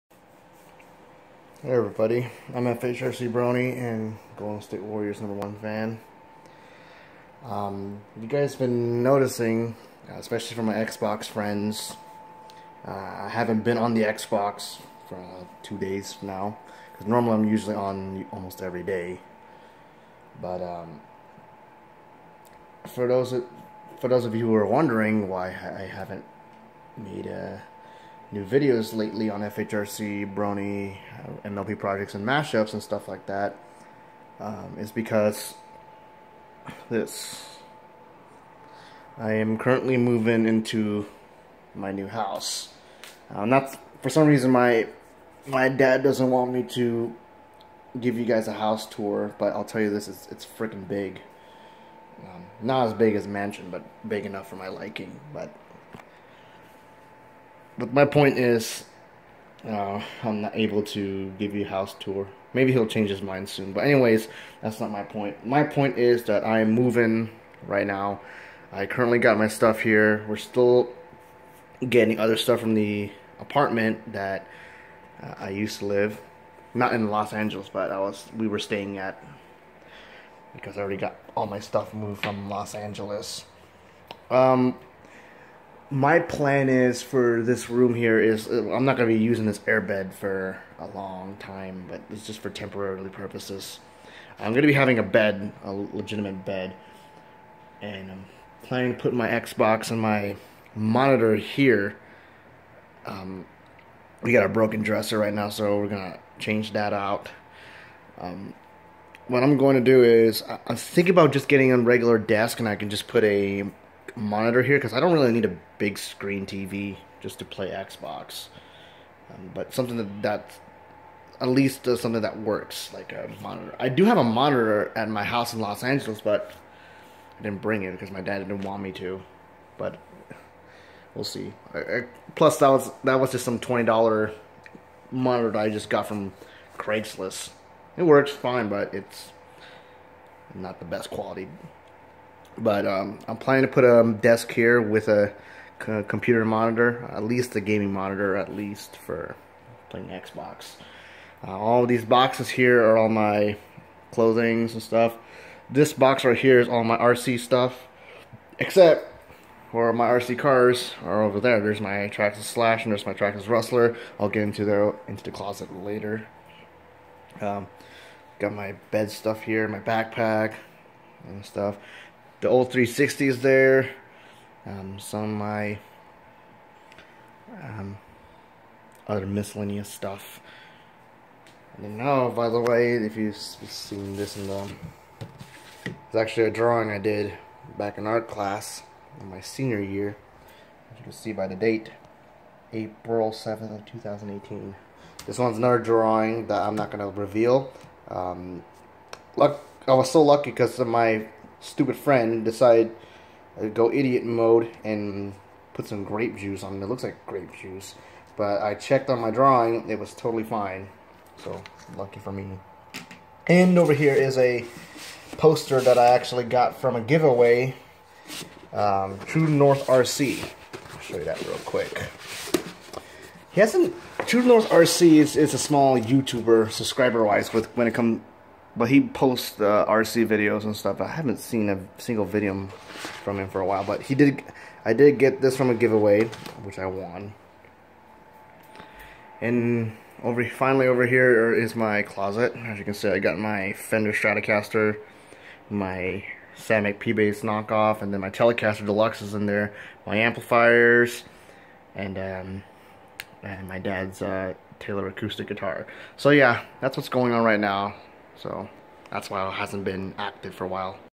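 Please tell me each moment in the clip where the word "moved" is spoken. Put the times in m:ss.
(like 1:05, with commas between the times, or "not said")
1:21.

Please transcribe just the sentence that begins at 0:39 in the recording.
I am currently moving into my new house.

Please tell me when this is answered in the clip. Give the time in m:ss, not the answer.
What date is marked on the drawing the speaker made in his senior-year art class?
3:12.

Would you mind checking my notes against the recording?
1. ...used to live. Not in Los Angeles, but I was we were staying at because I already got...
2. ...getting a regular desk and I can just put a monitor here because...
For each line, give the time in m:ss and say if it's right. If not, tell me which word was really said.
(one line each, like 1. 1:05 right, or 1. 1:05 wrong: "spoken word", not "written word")
1. 1:15 right
2. 1:51 right.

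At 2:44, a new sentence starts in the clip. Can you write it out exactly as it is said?
I'll get into the into the closet later.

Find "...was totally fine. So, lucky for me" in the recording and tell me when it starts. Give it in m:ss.
3:29.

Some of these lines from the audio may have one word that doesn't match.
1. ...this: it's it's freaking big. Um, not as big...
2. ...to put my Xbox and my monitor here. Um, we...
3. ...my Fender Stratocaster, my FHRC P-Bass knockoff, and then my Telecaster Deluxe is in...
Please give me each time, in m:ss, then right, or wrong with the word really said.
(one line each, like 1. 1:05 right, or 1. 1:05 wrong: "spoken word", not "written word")
1. 0:49 right
2. 1:38 right
3. 4:03 wrong: "Samick", not "FHRC".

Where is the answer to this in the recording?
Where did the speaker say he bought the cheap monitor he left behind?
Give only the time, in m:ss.
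2:16.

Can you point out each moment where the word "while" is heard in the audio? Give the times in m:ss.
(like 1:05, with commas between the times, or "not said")
3:53, 4:20.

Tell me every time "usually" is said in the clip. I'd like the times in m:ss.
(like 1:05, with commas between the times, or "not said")
0:17.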